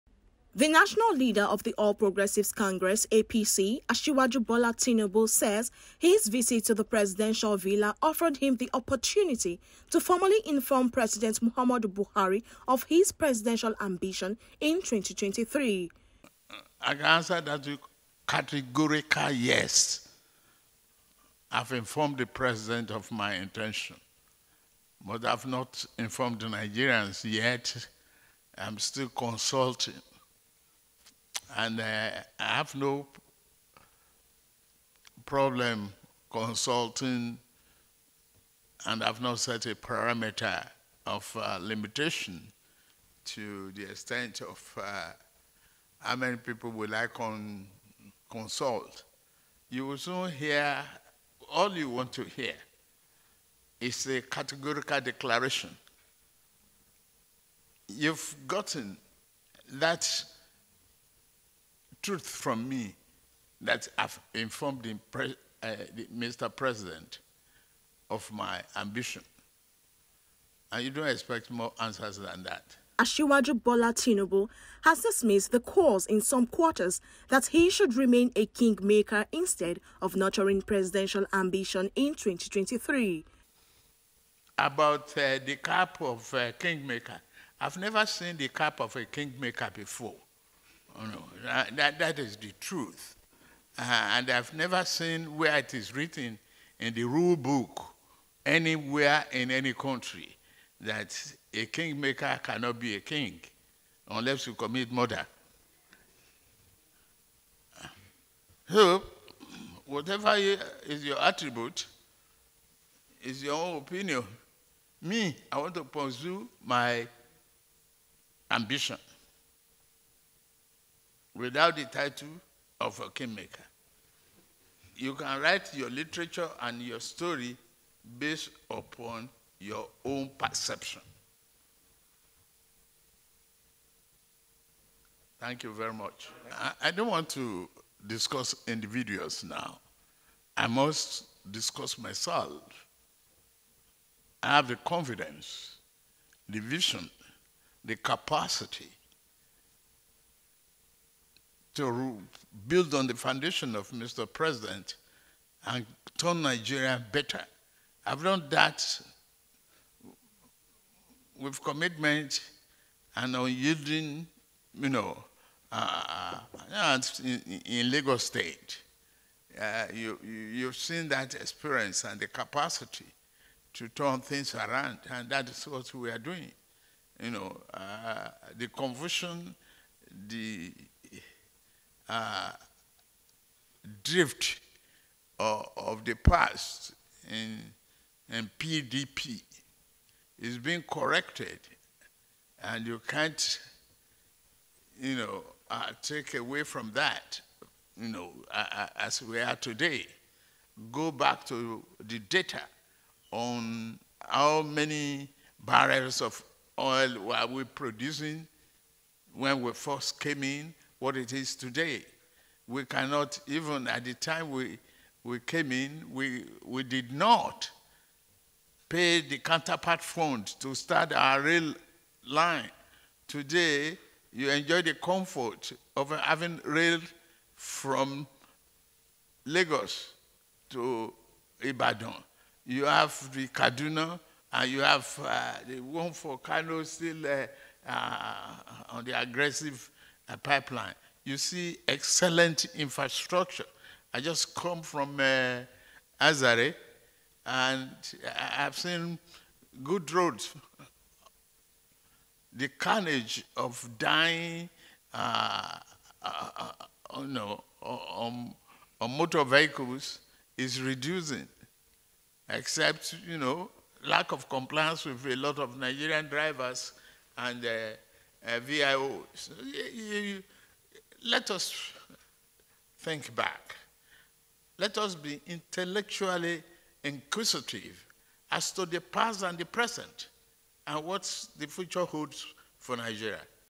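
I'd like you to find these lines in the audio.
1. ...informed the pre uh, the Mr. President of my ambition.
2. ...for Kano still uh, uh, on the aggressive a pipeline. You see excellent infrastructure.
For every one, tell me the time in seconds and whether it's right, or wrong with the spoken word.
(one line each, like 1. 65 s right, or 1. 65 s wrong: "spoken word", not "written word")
1. 64 s right
2. 236 s right.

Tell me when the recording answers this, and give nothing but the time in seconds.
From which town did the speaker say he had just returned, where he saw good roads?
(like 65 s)
246 s.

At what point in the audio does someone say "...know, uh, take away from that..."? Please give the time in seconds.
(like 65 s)
195 s.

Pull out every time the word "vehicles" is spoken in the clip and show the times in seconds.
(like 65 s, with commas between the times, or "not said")
259 s.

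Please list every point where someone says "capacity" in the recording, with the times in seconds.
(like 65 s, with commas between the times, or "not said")
147 s, 172 s.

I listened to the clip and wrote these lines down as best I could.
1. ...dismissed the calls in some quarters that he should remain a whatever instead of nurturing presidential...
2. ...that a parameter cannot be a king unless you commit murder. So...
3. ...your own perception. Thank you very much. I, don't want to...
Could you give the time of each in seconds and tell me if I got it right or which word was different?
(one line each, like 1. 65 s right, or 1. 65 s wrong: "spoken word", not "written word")
1. 75 s wrong: "kingmaker", not "whatever"
2. 100 s wrong: "kingmaker", not "parameter"
3. 129 s right.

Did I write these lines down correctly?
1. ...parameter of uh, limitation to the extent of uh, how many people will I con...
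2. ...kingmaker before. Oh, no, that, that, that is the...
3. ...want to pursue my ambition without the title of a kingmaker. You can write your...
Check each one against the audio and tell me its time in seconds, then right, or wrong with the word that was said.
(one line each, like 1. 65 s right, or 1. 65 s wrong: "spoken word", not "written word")
1. 39 s right
2. 89 s right
3. 115 s right.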